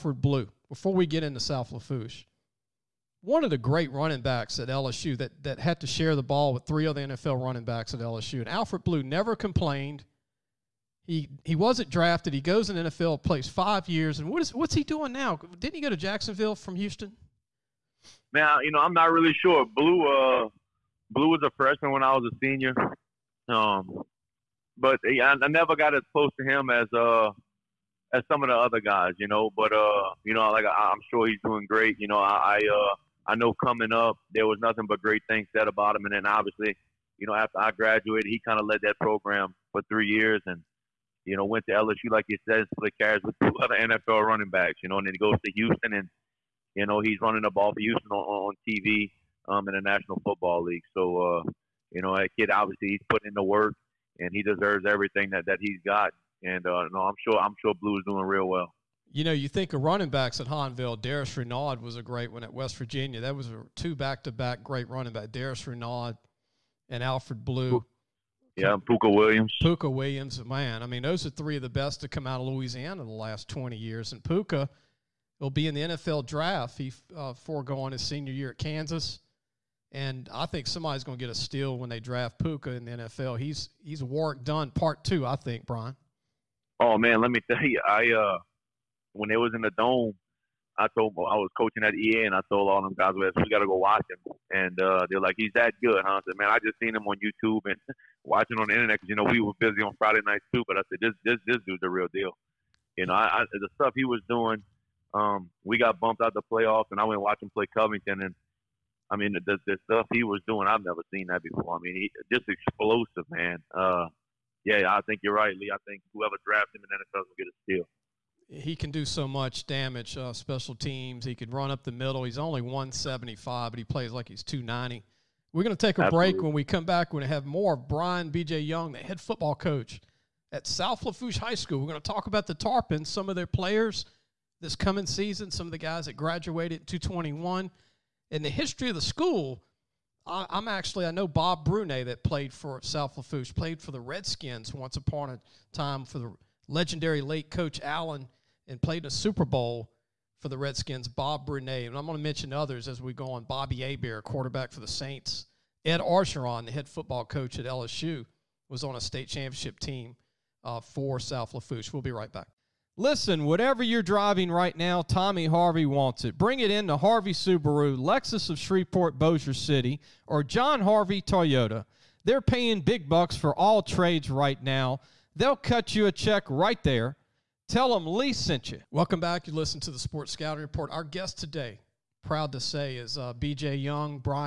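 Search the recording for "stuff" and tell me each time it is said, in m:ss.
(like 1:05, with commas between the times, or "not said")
1:43, 1:49.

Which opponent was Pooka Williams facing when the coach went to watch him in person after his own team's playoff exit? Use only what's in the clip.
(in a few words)
Covington.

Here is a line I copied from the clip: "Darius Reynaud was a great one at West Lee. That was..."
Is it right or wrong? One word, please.
wrong.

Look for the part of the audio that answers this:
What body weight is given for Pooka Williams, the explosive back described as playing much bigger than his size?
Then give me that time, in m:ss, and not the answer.
2:02.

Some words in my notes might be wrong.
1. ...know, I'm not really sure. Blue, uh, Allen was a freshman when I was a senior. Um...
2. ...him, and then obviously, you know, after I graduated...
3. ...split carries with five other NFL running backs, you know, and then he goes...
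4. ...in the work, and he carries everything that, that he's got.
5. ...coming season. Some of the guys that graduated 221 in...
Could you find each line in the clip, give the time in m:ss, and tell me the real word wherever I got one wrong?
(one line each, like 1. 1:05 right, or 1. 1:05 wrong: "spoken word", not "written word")
1. 0:18 wrong: "Blue", not "Allen"
2. 0:35 right
3. 0:42 wrong: "two", not "five"
4. 0:53 wrong: "deserves", not "carries"
5. 2:14 right.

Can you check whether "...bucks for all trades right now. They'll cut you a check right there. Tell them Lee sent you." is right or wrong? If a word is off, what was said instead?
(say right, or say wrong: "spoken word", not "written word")
right.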